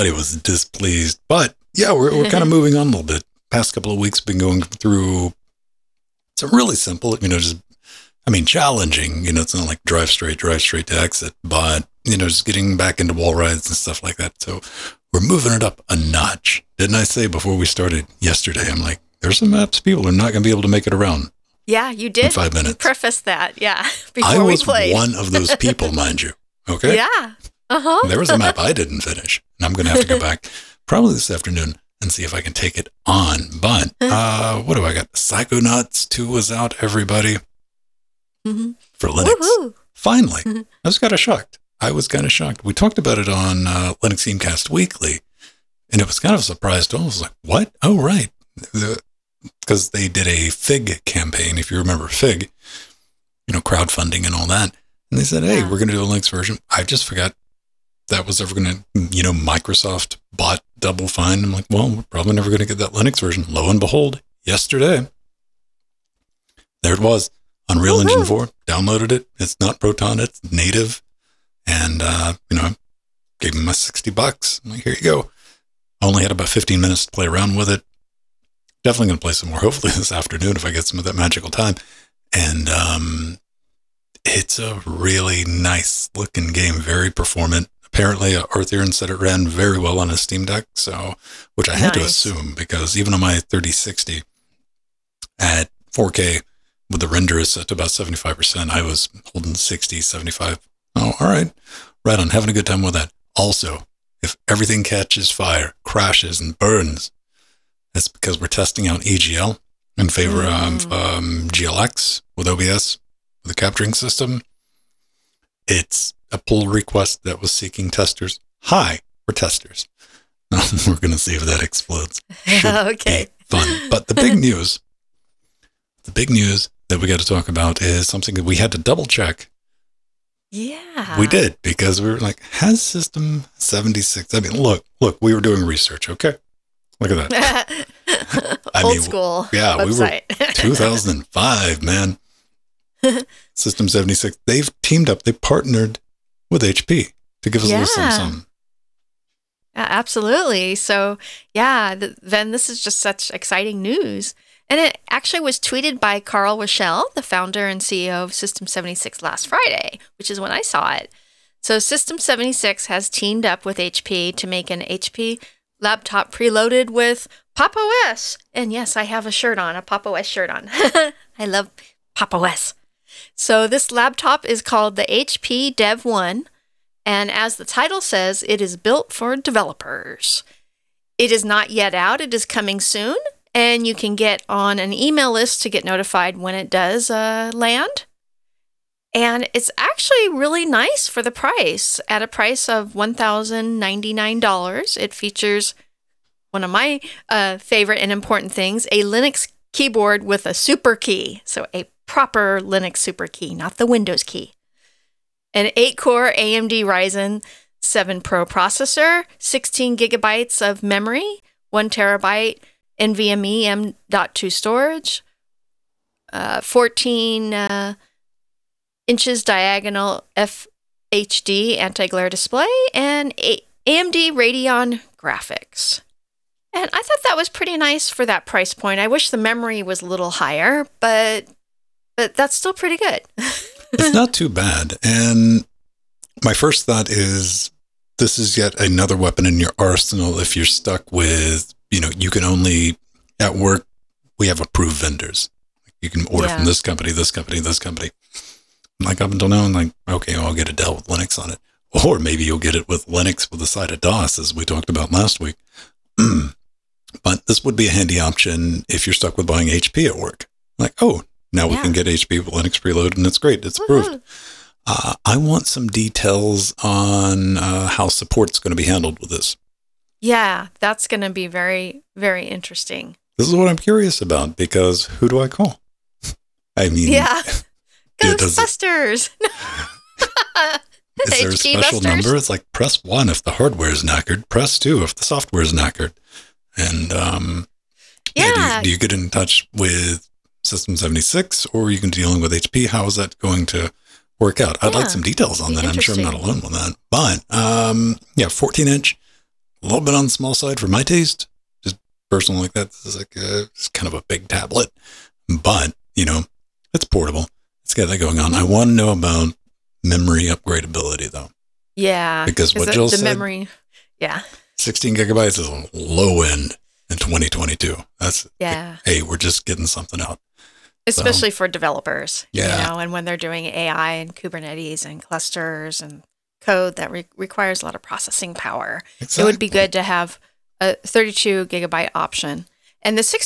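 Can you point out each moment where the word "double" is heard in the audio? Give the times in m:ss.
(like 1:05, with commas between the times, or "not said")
1:00, 2:08.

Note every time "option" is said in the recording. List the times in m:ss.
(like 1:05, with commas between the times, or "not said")
4:18, 5:32.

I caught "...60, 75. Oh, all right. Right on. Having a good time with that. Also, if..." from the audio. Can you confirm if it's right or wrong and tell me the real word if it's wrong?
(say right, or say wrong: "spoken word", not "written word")
right.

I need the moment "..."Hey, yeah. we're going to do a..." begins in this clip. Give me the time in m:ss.
0:55.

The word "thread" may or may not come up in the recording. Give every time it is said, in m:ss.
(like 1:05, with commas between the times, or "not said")
not said.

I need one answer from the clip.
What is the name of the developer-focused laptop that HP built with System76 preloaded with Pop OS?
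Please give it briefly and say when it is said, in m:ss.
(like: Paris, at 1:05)
HP Dev 1, at 2:55.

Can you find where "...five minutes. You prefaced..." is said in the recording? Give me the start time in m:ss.
0:22.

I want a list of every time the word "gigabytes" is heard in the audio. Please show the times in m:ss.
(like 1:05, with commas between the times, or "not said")
3:29, 5:15, 5:31.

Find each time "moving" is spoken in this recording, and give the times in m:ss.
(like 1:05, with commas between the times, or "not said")
0:02, 0:15.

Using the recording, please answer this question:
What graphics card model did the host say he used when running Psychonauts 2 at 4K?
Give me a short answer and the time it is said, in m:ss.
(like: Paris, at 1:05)
3060, at 1:33.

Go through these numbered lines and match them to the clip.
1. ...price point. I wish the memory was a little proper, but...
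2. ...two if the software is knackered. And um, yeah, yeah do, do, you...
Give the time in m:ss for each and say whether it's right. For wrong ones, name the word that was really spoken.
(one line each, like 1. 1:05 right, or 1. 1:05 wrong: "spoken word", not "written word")
1. 3:48 wrong: "higher", not "proper"
2. 4:44 right.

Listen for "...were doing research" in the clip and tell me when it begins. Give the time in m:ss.
2:15.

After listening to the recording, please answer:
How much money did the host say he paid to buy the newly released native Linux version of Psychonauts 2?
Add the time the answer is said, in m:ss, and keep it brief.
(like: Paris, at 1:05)
$60, at 1:13.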